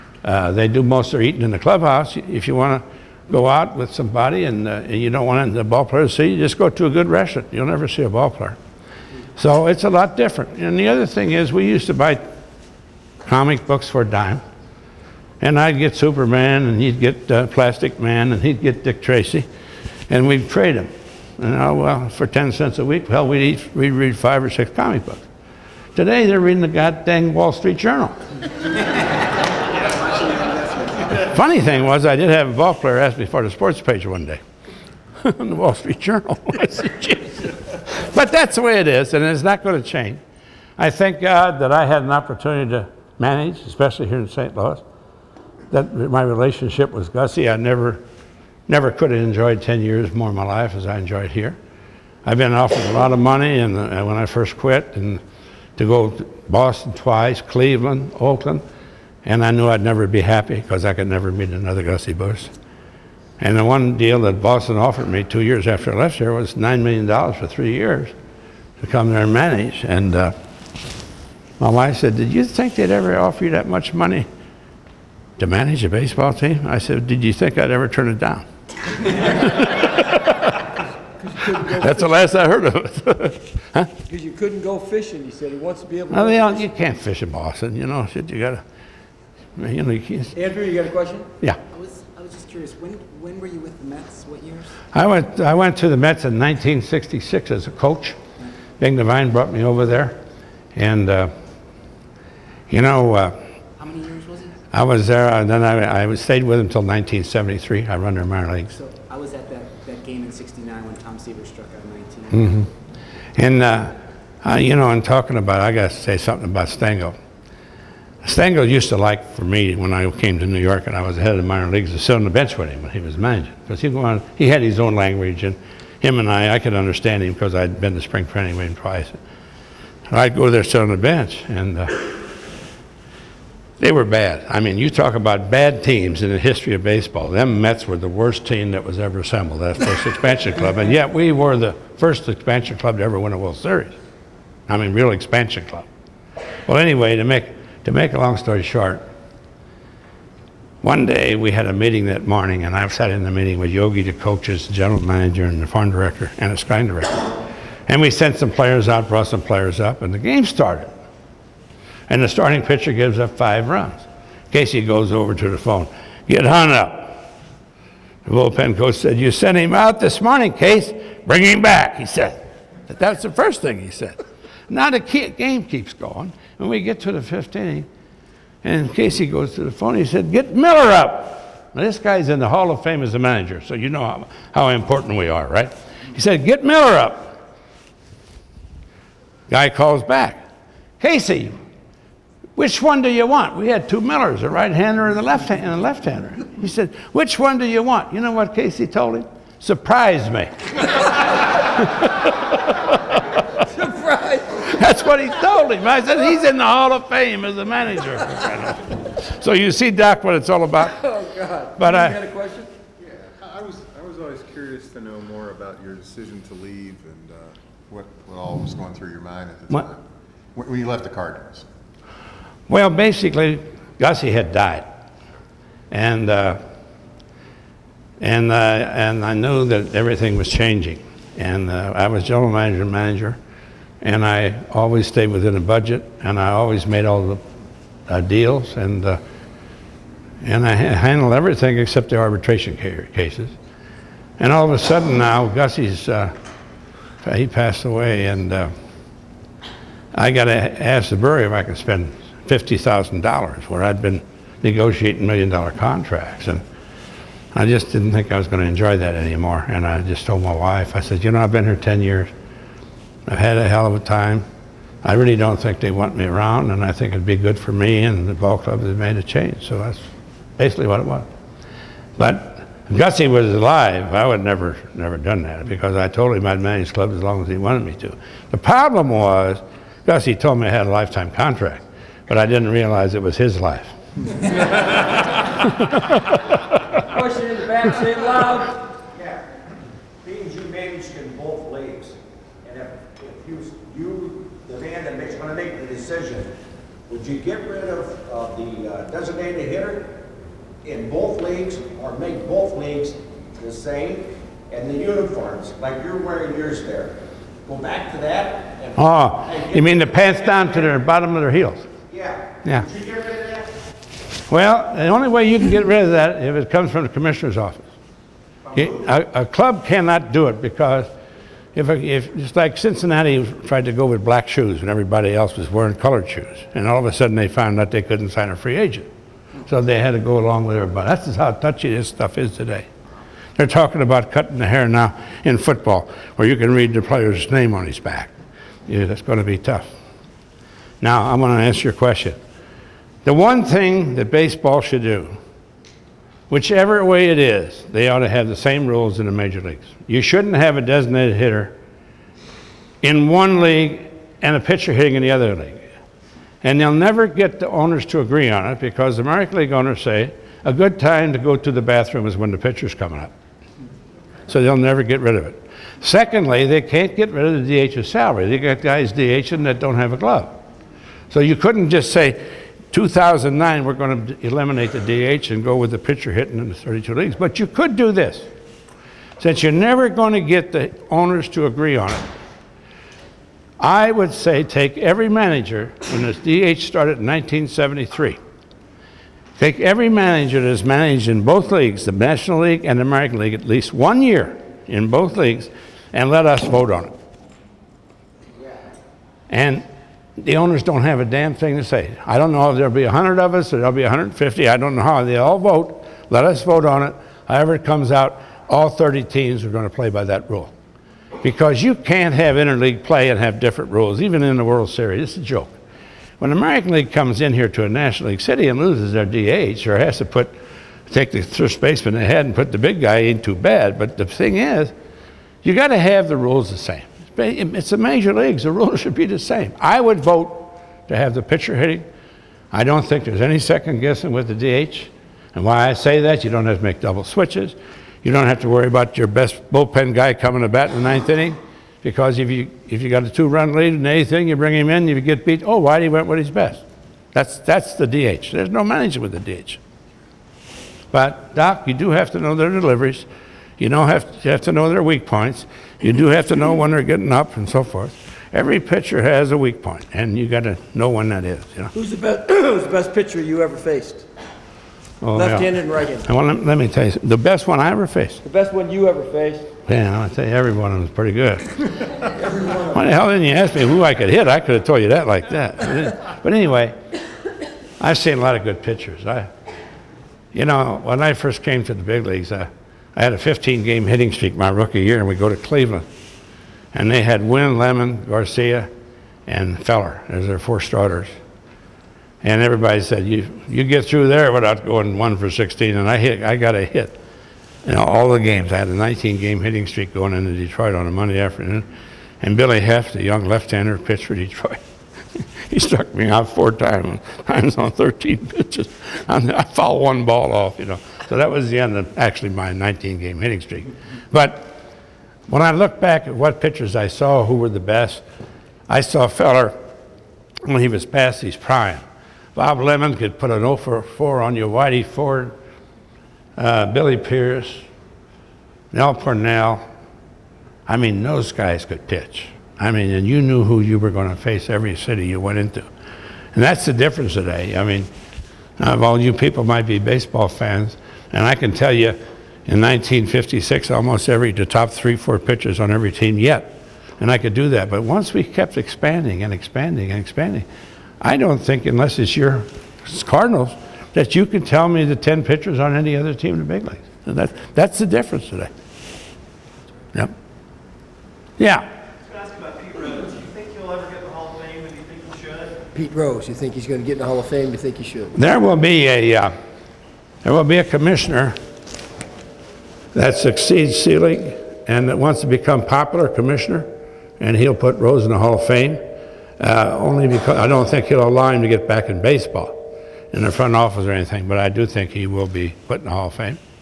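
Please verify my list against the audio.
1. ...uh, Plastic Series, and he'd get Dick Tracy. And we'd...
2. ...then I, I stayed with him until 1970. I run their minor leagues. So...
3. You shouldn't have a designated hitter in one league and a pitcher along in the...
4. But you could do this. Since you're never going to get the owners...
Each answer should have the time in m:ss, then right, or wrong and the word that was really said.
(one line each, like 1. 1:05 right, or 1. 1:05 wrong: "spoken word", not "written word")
1. 0:17 wrong: "Man", not "Series"
2. 1:45 wrong: "1973", not "1970"
3. 5:50 wrong: "hitting", not "along"
4. 6:17 right.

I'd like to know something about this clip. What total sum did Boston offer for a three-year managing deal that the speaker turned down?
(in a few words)
$9 million.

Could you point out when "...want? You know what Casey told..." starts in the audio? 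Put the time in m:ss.
3:17.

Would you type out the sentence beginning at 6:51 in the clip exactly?
Because you can't have interleague play and have different rules, even in the World Series.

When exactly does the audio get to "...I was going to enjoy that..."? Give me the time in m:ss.
4:18.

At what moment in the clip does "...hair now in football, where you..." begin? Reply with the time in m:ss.
5:34.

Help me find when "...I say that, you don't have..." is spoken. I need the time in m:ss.
7:15.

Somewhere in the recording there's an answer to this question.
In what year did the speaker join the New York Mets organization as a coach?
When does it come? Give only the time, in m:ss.
1:36.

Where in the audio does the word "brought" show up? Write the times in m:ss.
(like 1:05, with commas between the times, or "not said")
1:39, 2:39.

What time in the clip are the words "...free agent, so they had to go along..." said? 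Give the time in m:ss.
5:28.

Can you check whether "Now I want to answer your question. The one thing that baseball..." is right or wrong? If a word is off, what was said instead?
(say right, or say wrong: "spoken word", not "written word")
right.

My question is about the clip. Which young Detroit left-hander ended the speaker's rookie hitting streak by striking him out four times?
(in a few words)
Billy Hoeft.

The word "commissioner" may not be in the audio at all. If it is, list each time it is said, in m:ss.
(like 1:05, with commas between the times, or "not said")
5:17, 9:30, 9:36.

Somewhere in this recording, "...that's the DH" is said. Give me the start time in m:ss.
7:27.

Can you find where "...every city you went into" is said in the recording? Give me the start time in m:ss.
8:54.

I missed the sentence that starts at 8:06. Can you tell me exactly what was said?
And they had Wynn, Lemon, Garcia, and Feller as their four starters.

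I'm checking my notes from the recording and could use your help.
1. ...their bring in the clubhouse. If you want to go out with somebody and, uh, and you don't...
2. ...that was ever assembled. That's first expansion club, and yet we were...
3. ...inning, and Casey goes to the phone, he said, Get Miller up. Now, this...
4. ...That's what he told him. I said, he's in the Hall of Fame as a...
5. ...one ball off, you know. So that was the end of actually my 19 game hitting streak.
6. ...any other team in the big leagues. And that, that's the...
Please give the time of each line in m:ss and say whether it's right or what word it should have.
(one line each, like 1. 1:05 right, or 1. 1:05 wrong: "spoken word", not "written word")
1. 0:01 wrong: "eating", not "bring"
2. 2:18 right
3. 2:57 right
4. 3:24 right
5. 8:30 right
6. 9:15 right.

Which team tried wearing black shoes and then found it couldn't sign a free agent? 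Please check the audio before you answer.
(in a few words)
Cincinnati.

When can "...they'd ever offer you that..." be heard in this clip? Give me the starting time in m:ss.
1:12.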